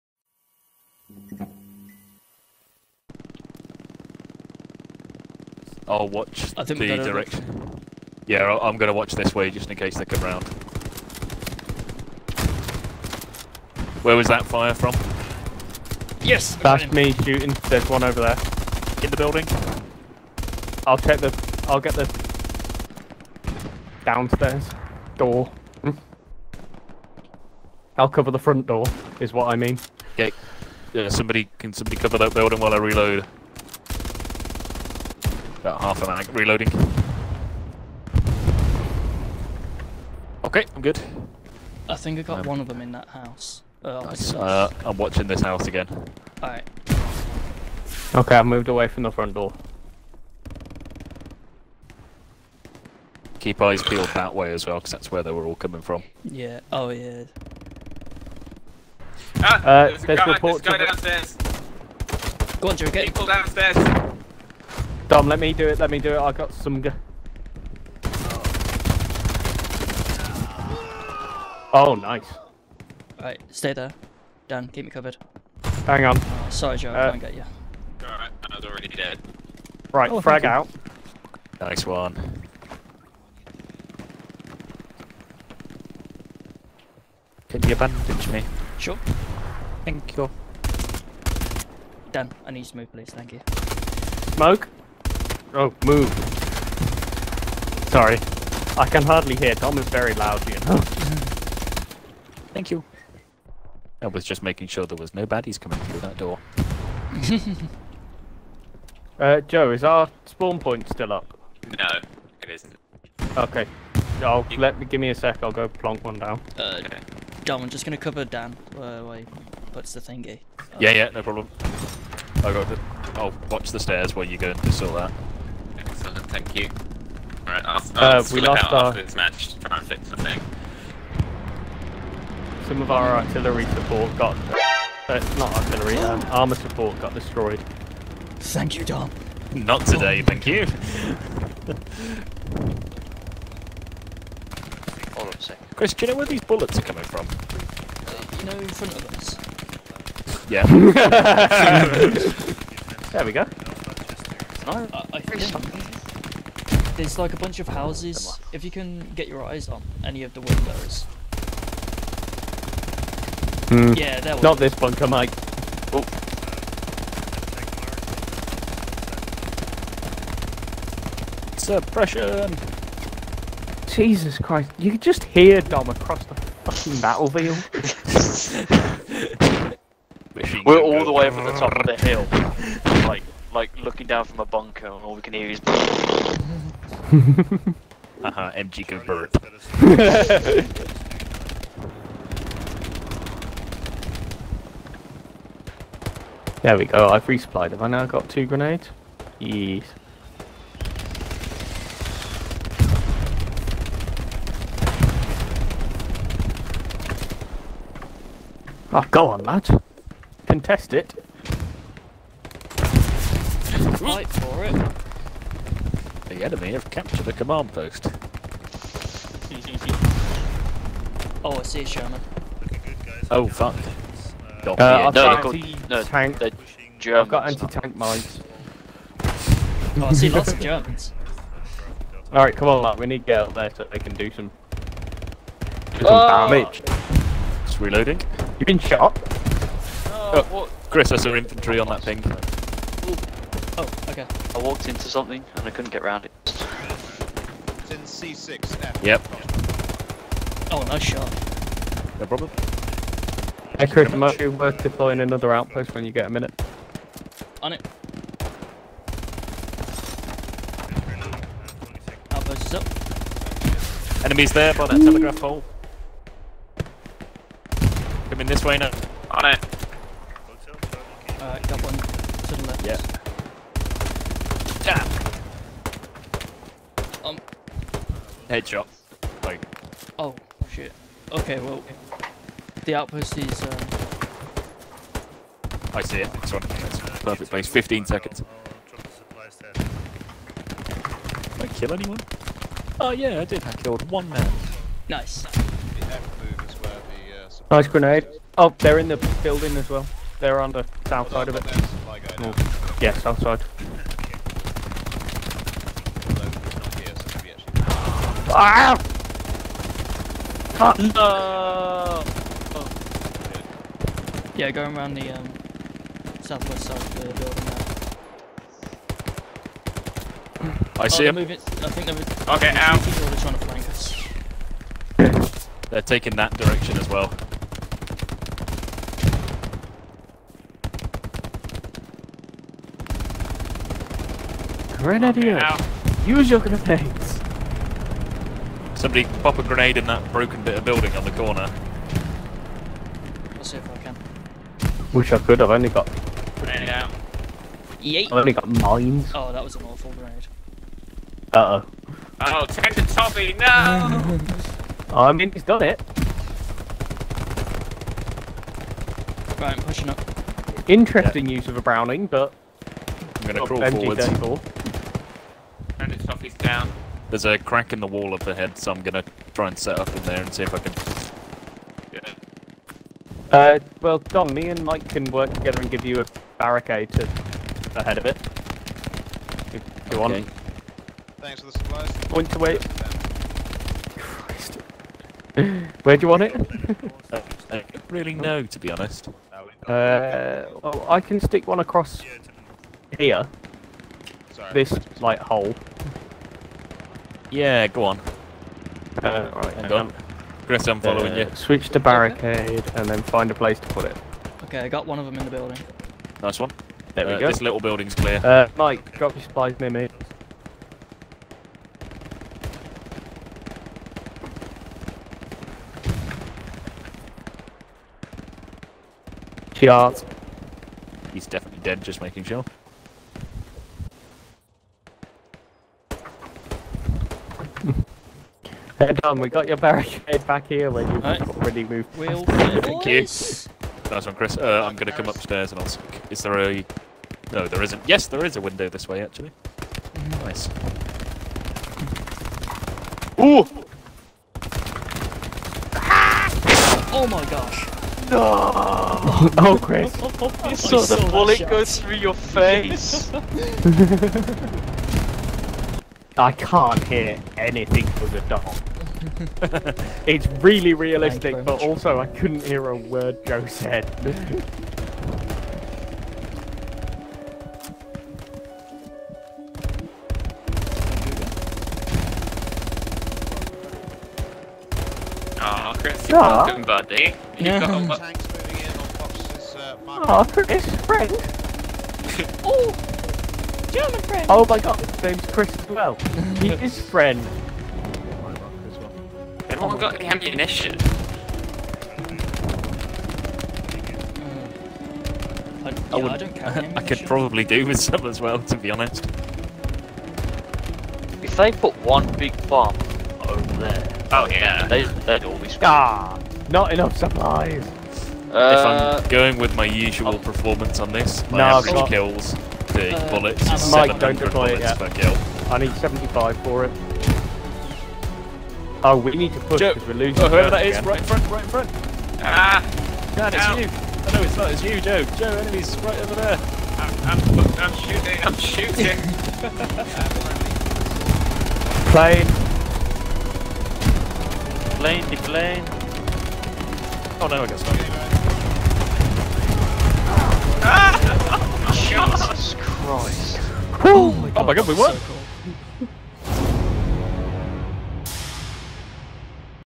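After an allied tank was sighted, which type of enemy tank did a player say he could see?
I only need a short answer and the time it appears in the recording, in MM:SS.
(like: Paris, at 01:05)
Sherman, at 03:41.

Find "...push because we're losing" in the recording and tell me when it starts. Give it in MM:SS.
08:39.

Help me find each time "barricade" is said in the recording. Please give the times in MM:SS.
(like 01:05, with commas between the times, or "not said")
06:16, 06:41, 07:09.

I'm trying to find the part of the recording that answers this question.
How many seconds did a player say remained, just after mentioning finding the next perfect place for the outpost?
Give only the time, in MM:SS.
04:47.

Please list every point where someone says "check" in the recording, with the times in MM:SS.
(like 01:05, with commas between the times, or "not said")
00:20.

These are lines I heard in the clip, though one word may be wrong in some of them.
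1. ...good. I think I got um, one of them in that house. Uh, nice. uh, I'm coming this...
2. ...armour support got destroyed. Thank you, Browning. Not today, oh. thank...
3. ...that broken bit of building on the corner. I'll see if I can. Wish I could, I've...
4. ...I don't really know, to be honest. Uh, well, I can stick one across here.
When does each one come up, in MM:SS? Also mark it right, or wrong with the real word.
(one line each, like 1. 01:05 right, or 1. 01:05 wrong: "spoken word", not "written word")
1. 00:40 wrong: "watching", not "coming"
2. 02:16 wrong: "Dom", not "Browning"
3. 05:40 right
4. 06:27 right.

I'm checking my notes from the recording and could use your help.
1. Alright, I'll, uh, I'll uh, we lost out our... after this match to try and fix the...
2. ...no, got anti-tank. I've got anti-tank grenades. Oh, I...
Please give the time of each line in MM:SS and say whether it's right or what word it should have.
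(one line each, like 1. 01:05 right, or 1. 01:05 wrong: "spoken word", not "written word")
1. 02:07 right
2. 03:45 wrong: "mines", not "grenades".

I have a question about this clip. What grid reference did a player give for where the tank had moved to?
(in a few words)
C6.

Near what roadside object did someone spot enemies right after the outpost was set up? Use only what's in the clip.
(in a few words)
telegraph pole.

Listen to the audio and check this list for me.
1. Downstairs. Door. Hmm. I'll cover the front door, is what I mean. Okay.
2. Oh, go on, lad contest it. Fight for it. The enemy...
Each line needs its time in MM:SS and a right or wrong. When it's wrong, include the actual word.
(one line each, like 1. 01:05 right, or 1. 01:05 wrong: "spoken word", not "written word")
1. 00:24 right
2. 03:28 right.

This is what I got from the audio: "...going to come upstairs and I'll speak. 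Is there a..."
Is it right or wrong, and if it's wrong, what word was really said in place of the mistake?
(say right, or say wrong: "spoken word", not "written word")
right.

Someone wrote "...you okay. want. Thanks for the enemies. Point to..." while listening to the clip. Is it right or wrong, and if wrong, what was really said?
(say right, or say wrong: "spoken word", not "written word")
wrong: "supplies", not "enemies".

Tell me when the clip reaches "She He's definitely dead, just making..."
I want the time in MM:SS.
06:59.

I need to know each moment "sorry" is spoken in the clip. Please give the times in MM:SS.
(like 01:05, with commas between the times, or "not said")
01:16, 01:37, 06:34.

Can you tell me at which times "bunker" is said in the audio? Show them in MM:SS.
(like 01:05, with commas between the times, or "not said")
02:44, 03:04.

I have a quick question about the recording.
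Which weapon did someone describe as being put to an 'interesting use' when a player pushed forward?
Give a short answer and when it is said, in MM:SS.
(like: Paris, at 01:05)
Browning, at 06:01.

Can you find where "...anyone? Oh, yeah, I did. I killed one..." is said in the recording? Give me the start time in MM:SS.
04:51.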